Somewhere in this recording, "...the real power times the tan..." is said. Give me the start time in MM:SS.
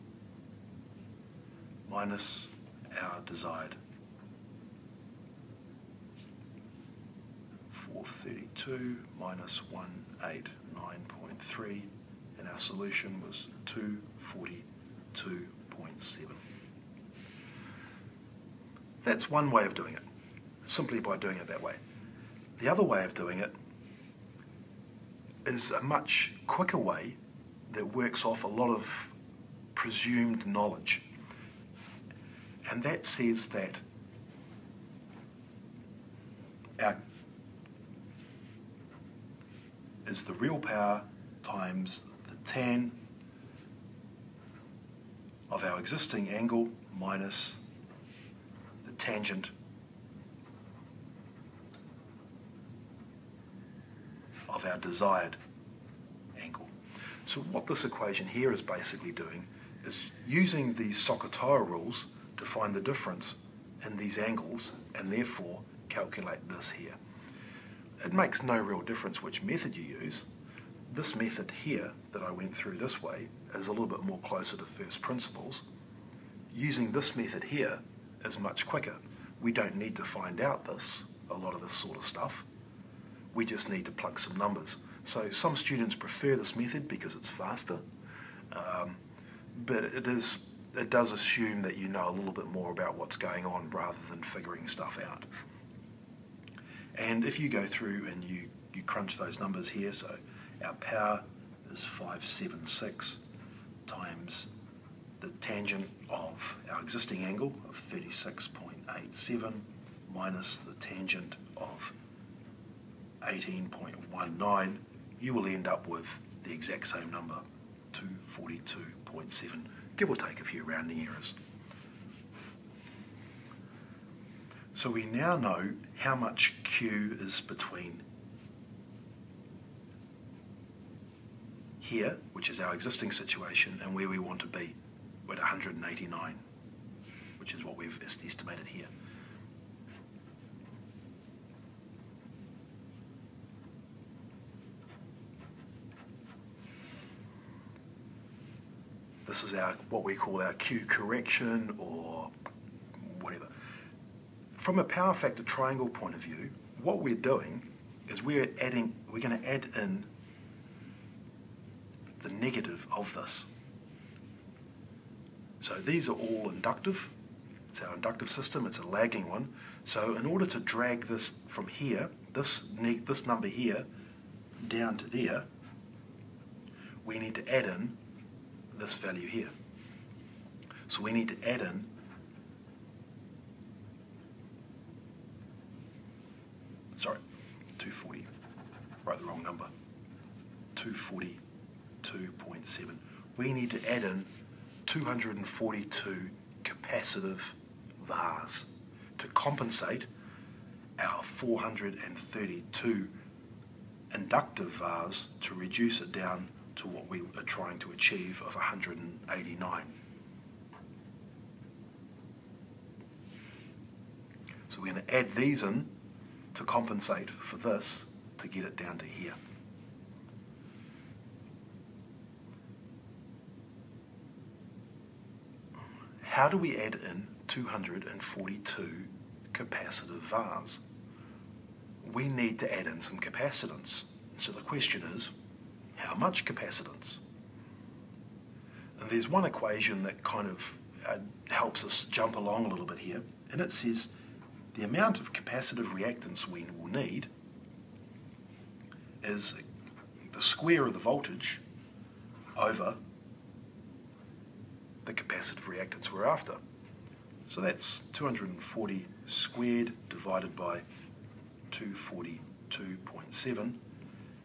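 00:40.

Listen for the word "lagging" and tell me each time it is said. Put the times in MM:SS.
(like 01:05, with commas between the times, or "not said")
02:48.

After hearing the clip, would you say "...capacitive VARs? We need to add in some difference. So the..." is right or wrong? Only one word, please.
wrong.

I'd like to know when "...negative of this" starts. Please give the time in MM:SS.
02:42.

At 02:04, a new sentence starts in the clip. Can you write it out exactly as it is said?
So we now know how much Q is between here, which is our existing situation, and where we want to be.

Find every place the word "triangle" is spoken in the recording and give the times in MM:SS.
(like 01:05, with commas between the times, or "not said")
02:35.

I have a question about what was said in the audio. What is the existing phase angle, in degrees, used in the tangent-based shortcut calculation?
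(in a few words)
36.87.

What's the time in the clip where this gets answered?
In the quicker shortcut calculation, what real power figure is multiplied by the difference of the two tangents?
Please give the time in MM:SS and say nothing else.
01:41.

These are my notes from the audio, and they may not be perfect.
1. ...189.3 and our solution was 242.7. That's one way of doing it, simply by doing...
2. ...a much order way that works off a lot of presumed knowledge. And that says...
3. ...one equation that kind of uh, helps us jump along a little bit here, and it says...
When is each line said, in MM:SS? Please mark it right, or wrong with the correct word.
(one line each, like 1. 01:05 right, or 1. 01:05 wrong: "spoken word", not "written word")
1. 00:10 right
2. 00:25 wrong: "quicker", not "order"
3. 03:59 right.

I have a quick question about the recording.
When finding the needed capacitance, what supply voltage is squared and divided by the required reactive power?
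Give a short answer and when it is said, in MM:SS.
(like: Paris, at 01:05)
240, at 04:18.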